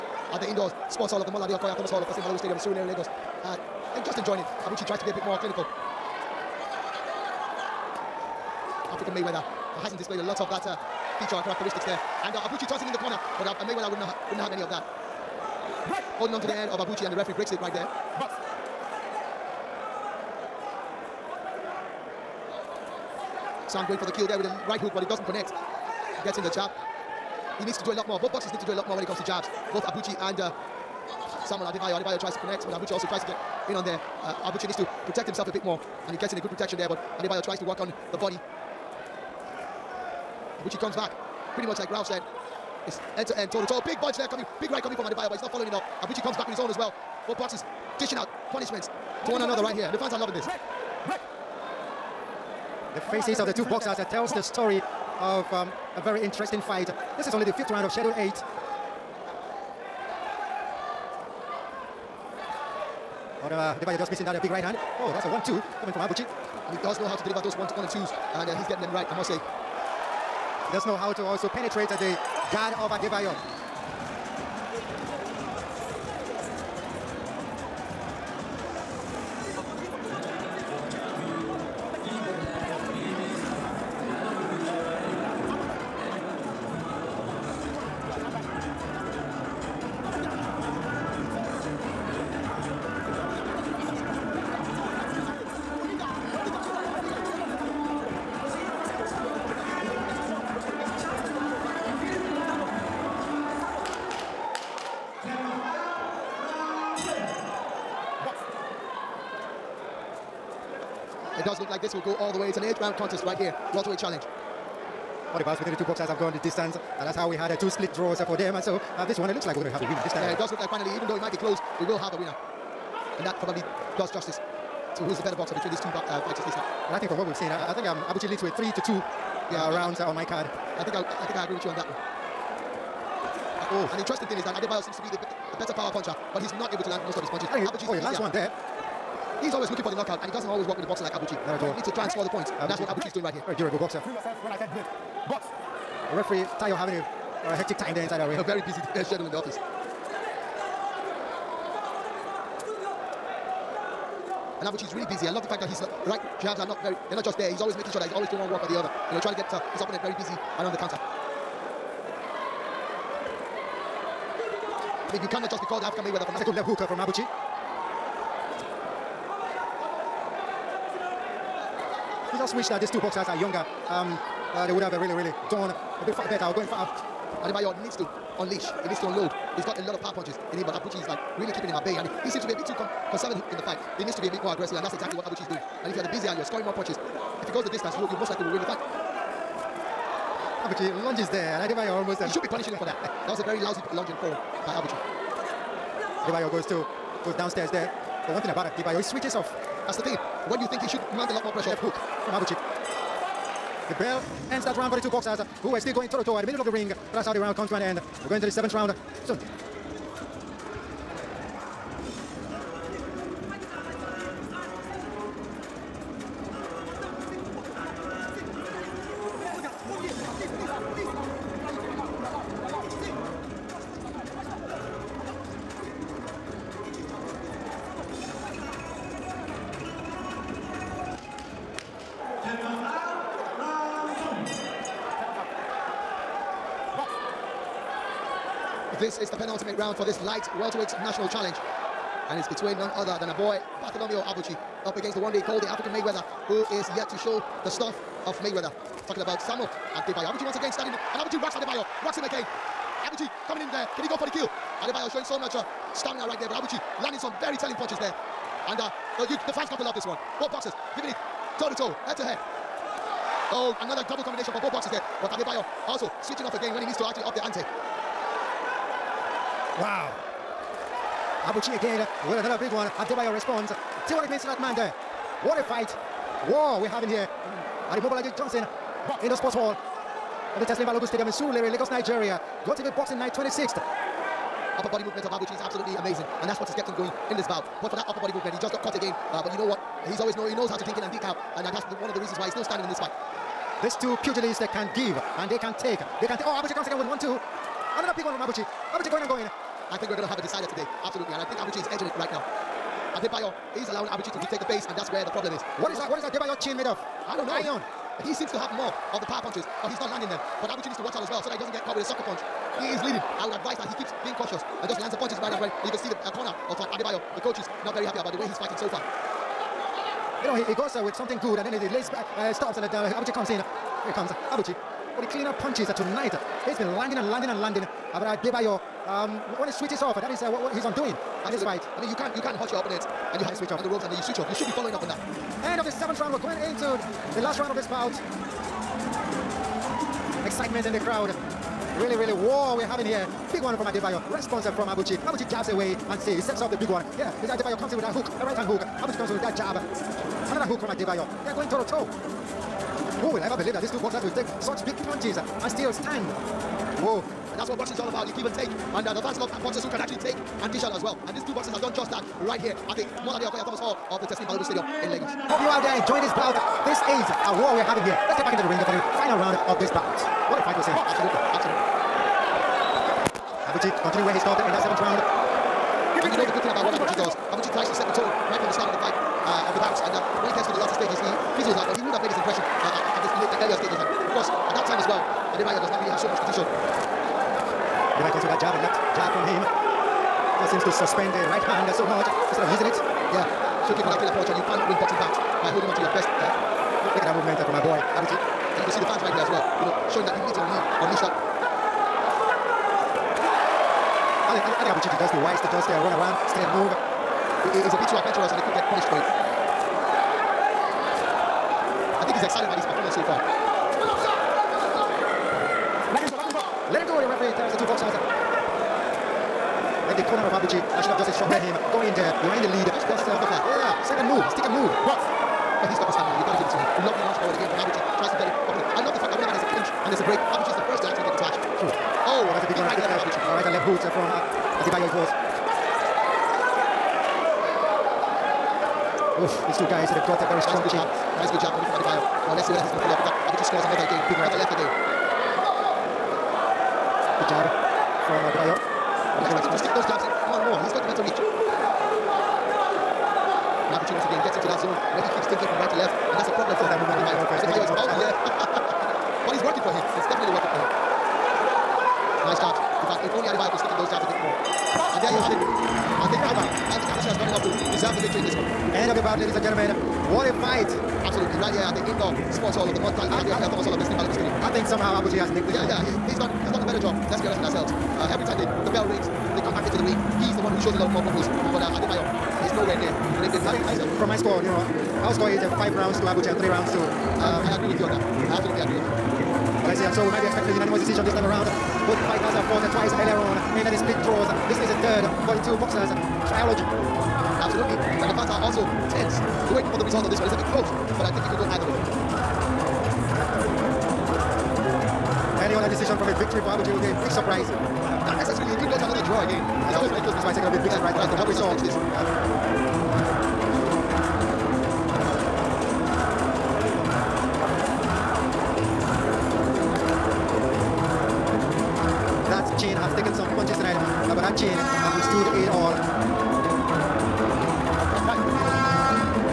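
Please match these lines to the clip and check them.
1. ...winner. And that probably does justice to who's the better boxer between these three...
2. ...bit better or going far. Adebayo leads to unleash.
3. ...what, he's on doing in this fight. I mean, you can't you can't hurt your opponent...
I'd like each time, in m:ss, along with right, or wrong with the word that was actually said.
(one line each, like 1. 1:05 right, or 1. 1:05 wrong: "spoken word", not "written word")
1. 2:02 wrong: "two", not "three"
2. 2:56 wrong: "needs", not "leads"
3. 5:30 right.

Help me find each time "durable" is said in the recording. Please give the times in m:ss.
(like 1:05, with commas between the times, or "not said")
2:23.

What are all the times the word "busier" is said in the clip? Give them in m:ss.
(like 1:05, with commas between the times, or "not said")
3:06.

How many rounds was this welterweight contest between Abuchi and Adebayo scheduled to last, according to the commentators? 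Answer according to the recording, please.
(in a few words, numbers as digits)
8.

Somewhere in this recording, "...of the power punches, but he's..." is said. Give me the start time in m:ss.
5:09.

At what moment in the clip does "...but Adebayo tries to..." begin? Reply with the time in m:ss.
0:36.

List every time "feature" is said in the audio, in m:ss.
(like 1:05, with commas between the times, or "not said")
0:11.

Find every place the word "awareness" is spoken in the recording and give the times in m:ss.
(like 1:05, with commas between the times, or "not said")
not said.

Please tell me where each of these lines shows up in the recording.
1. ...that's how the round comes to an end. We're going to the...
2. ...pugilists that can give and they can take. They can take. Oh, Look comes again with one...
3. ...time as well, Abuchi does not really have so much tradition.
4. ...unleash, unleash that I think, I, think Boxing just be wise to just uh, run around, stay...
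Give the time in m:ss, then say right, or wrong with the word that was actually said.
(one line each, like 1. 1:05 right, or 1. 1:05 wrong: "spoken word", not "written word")
1. 3:27 right
2. 4:54 wrong: "Abuchi", not "Look"
3. 6:24 wrong: "Adebayo", not "Abuchi"
4. 6:40 wrong: "Abuchichi", not "Boxing".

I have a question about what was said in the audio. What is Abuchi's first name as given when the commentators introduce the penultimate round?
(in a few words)
Bartholomew.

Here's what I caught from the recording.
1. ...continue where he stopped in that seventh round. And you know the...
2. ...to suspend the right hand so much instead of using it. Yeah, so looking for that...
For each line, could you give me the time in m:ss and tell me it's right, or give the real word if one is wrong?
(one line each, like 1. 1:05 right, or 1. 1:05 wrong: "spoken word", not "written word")
1. 6:14 right
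2. 6:30 right.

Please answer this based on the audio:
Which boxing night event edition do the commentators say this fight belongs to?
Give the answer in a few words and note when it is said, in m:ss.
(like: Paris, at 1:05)
GOtv Boxing Night 26th, at 4:42.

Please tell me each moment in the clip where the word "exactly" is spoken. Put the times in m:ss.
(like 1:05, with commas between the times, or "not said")
3:04.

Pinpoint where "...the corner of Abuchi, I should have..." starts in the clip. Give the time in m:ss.
7:00.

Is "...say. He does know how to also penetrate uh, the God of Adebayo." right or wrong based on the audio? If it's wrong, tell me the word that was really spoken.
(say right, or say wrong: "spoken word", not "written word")
right.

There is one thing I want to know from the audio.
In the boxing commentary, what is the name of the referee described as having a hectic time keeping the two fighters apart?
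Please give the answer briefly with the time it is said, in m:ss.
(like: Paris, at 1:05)
Tayo, at 2:26.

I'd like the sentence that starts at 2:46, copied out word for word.
That's a good left hook uh, from Abuchi.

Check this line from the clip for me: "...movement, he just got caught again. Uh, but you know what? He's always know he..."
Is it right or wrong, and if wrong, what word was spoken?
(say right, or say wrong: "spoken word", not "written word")
right.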